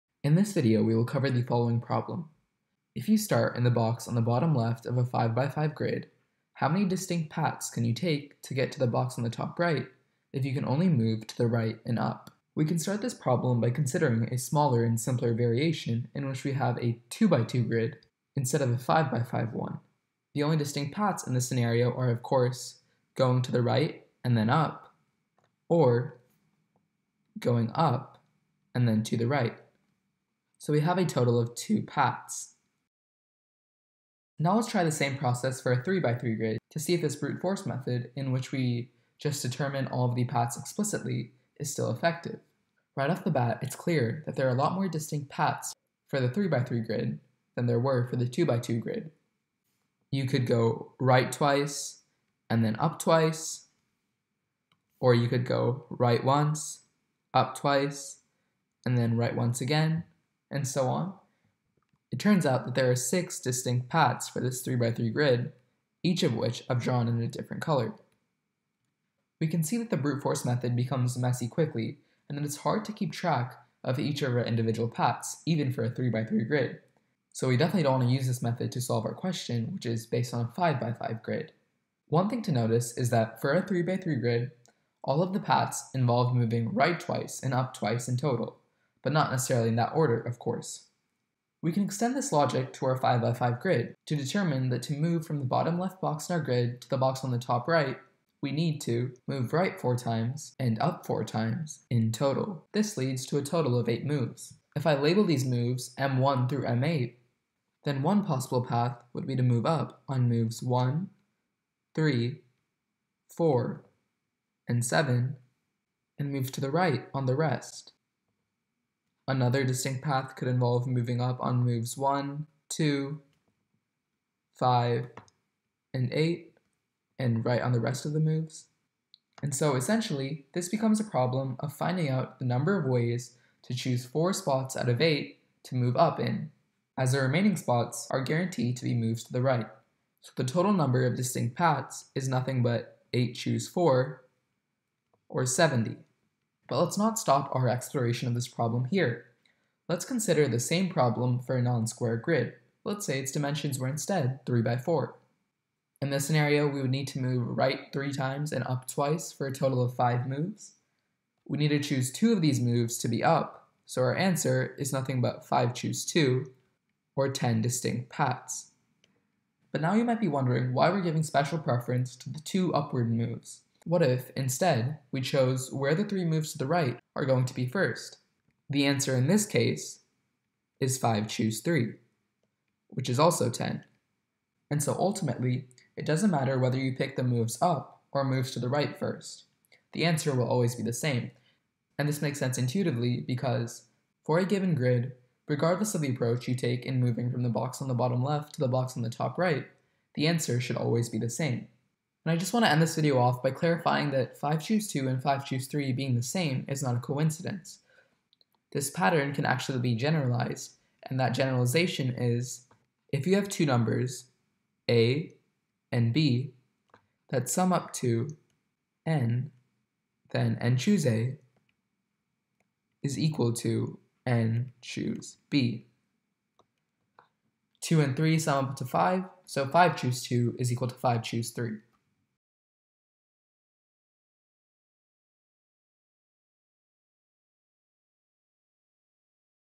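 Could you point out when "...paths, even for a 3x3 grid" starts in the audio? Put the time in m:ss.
1:14.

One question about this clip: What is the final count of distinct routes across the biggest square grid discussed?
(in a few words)
70.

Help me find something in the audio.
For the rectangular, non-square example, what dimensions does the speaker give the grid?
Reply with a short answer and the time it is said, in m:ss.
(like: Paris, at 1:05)
3 by 4, at 2:34.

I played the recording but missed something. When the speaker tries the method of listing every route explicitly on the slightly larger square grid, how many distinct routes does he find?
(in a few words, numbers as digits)
6.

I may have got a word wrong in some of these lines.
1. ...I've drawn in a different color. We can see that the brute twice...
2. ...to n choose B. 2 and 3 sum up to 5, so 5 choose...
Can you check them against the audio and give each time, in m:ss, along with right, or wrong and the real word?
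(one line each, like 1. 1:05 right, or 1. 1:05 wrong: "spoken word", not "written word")
1. 1:06 wrong: "force", not "twice"
2. 3:43 right.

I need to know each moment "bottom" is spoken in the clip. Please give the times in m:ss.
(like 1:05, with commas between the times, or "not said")
0:04, 1:35, 3:17.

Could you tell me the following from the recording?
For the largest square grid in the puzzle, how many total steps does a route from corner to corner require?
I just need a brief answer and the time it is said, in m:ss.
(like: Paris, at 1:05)
8, at 1:43.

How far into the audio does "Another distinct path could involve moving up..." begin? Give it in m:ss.
1:59.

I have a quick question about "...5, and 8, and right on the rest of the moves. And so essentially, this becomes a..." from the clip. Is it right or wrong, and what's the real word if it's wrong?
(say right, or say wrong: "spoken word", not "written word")
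right.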